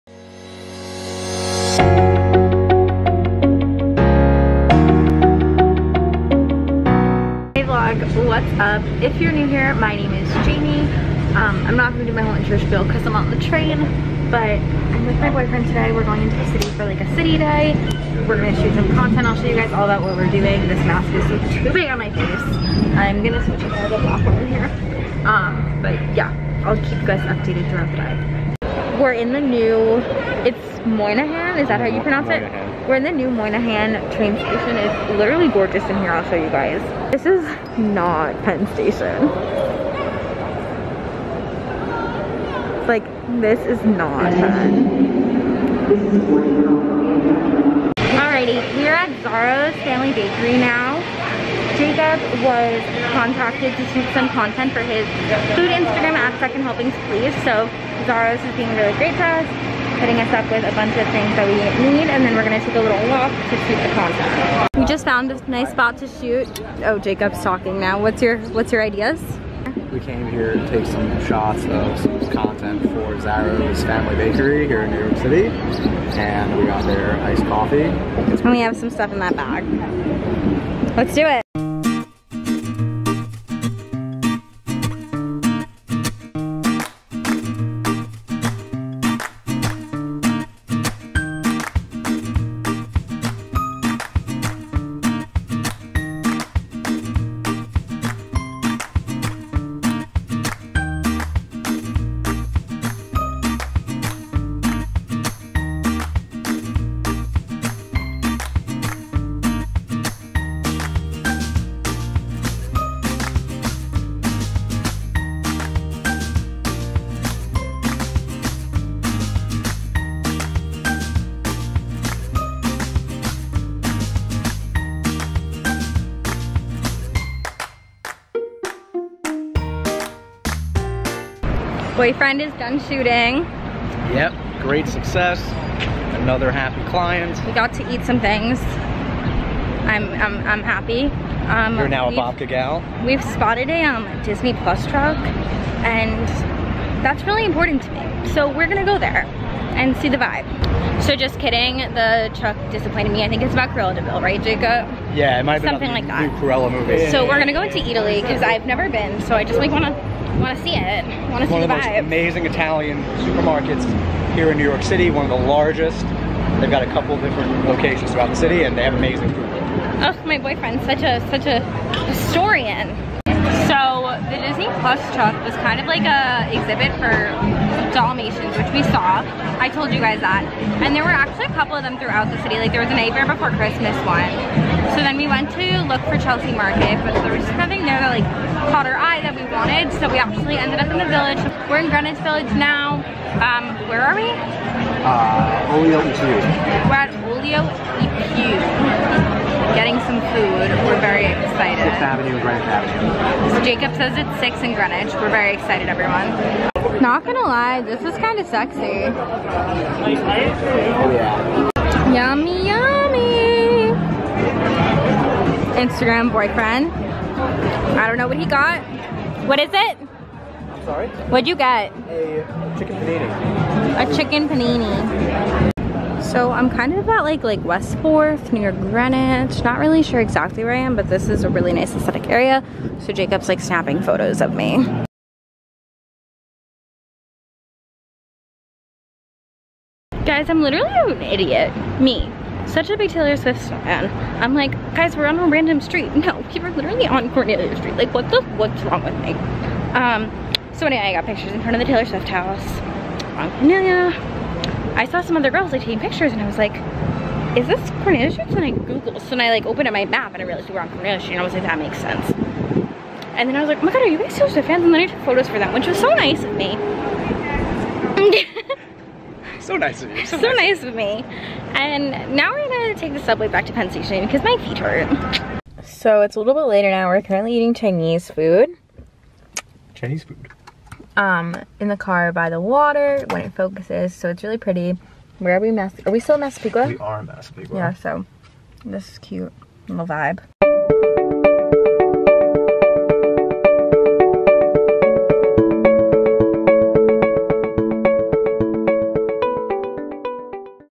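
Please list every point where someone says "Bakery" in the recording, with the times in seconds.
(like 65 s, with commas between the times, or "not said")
50 s, 74 s.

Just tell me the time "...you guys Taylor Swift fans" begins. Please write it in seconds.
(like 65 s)
264 s.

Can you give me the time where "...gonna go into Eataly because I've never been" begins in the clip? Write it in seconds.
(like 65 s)
157 s.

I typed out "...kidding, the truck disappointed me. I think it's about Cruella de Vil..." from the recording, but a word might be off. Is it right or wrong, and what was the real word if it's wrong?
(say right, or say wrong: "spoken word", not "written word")
right.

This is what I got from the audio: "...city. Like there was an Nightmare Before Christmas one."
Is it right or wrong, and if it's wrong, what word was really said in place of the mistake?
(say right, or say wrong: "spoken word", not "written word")
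right.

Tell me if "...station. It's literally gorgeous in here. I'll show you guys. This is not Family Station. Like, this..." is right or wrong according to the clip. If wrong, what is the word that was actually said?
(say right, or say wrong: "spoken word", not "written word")
wrong: "Penn", not "Family".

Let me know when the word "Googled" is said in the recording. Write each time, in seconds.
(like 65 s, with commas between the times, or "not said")
258 s.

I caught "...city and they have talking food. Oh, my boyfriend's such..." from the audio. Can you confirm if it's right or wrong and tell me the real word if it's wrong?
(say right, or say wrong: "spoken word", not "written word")
wrong: "amazing", not "talking".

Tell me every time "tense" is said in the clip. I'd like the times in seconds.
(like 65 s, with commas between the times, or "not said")
not said.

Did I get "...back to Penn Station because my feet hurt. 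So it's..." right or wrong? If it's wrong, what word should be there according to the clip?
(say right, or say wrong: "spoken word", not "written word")
right.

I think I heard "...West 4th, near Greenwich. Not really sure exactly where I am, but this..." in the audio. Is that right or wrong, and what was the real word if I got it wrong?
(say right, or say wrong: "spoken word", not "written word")
right.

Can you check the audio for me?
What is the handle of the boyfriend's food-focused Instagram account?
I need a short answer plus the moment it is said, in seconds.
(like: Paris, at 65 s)
Second Helpings Please, at 56 s.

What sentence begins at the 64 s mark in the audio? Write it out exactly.
We just found a nice spot to shoot.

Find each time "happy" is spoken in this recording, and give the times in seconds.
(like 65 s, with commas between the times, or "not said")
136 s, 140 s.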